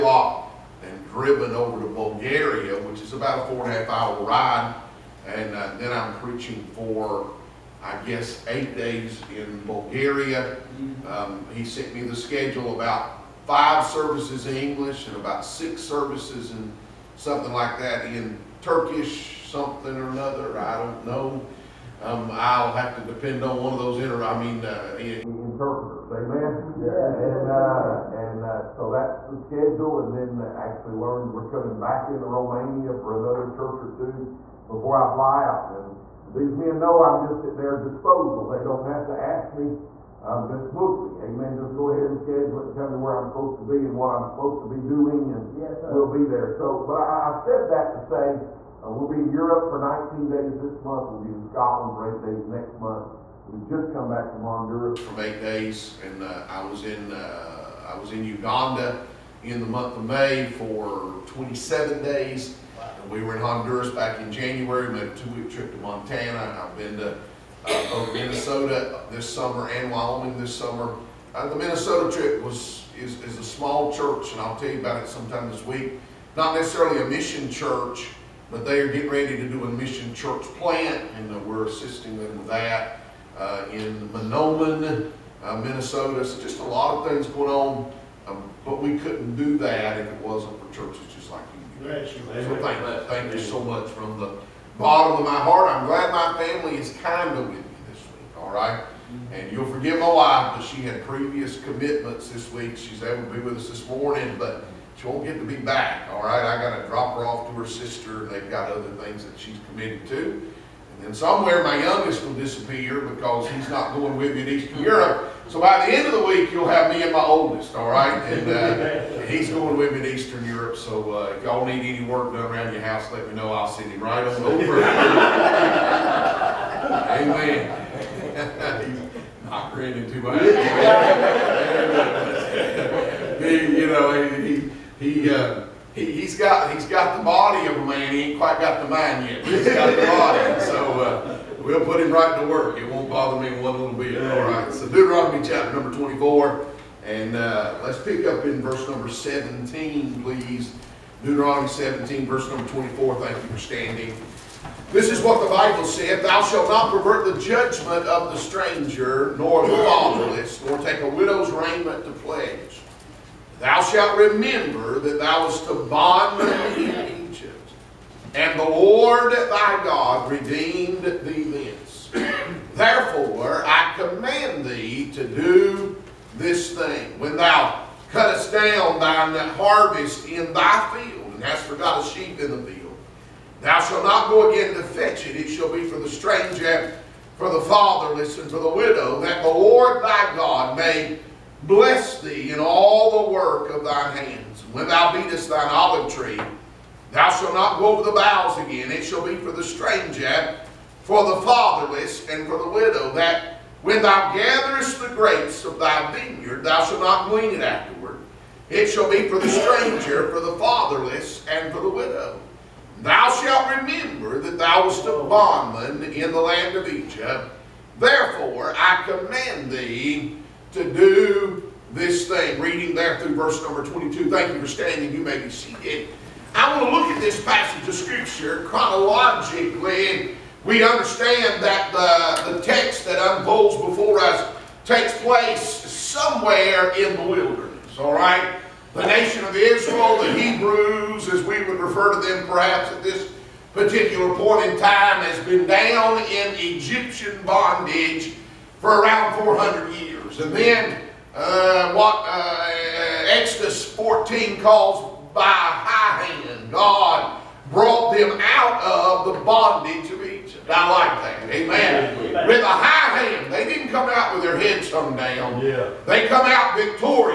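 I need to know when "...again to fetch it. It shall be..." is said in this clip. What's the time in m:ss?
3:04.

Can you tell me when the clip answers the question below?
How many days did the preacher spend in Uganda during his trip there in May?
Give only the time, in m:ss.
1:01.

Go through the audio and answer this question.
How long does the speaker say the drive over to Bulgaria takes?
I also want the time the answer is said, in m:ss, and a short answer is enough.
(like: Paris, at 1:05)
4.5 hours, at 0:03.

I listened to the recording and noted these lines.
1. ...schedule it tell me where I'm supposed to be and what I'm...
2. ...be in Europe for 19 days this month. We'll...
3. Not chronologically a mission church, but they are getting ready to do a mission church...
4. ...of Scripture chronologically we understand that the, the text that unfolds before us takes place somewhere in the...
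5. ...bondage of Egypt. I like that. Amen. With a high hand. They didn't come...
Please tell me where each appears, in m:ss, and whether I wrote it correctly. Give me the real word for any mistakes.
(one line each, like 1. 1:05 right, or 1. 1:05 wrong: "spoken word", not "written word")
1. 0:42 right
2. 0:49 right
3. 1:16 wrong: "necessarily", not "chronologically"
4. 3:47 right
5. 4:19 right.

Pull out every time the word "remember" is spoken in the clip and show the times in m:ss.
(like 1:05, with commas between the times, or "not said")
2:44, 3:33.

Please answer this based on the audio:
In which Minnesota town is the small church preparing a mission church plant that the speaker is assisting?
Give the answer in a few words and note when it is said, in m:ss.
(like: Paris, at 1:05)
Mahnomen, at 1:24.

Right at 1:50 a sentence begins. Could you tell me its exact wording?
And then somewhere my youngest will disappear because he's not going with me to Eastern Europe.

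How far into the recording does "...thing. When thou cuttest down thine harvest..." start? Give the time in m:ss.
2:56.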